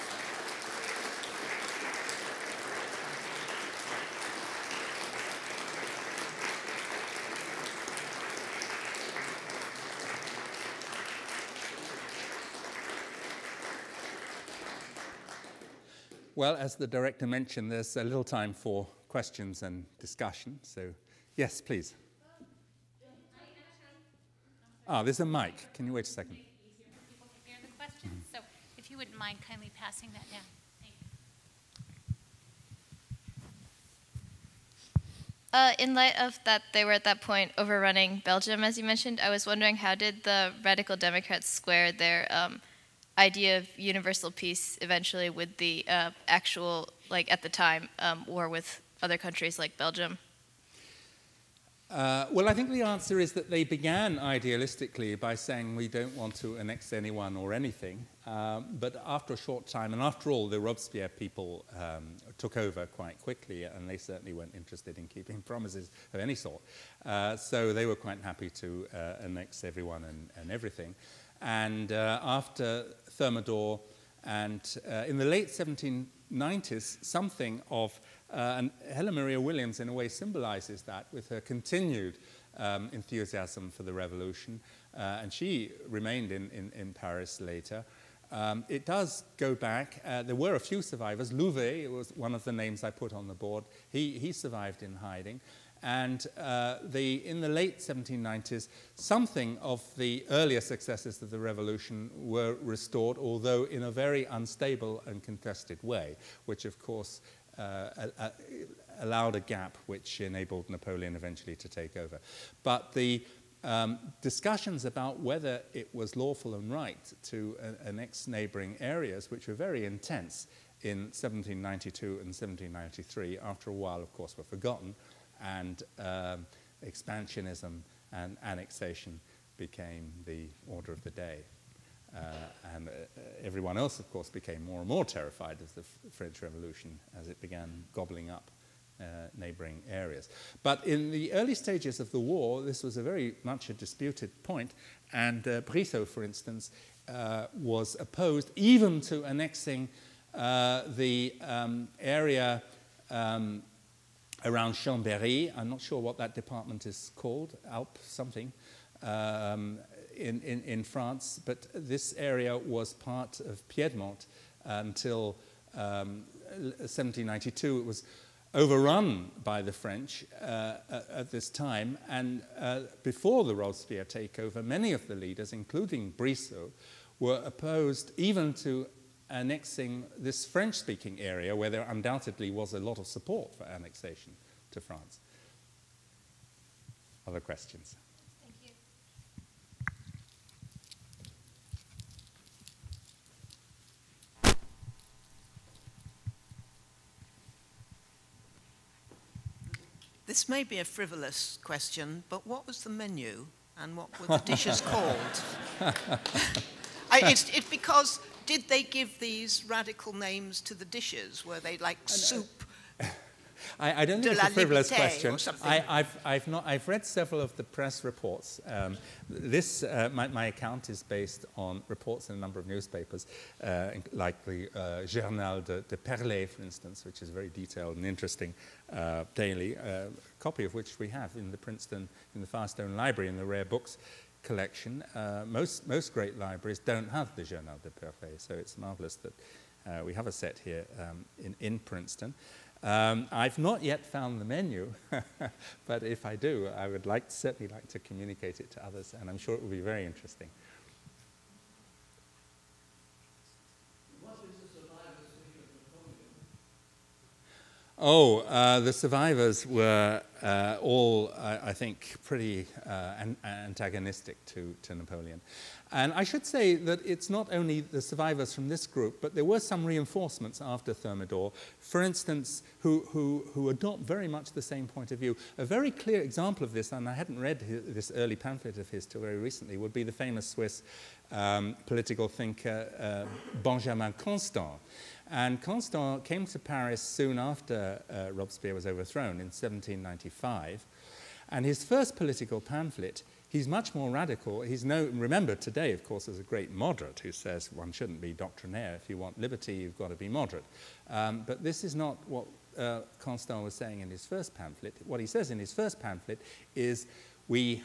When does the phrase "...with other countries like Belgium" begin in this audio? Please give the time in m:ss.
0:48.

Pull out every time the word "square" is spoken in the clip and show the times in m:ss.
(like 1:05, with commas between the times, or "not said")
0:41.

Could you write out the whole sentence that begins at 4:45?
And Constant came to Paris soon after uh, Robespierre was overthrown in 1795.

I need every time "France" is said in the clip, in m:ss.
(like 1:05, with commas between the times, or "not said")
2:40, 3:04.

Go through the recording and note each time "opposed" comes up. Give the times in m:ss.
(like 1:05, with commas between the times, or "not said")
2:27, 2:57.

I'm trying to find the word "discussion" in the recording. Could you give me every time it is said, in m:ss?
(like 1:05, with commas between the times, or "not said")
0:19, 1:54.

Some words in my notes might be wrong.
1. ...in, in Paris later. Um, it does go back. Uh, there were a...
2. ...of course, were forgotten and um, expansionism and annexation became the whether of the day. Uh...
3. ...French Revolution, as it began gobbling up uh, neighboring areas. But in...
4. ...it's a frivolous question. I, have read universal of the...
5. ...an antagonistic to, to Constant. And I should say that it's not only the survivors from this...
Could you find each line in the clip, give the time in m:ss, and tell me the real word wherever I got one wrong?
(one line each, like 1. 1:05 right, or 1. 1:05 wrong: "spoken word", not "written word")
1. 1:26 right
2. 2:04 wrong: "order", not "whether"
3. 2:16 right
4. 3:34 wrong: "several", not "universal"
5. 4:23 wrong: "Napoleon", not "Constant".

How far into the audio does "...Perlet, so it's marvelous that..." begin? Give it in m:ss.
3:57.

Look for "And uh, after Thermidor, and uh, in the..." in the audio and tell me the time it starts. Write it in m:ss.
1:11.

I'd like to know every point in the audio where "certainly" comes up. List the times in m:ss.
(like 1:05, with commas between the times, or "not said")
1:03, 4:07.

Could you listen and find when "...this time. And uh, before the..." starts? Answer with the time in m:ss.
2:51.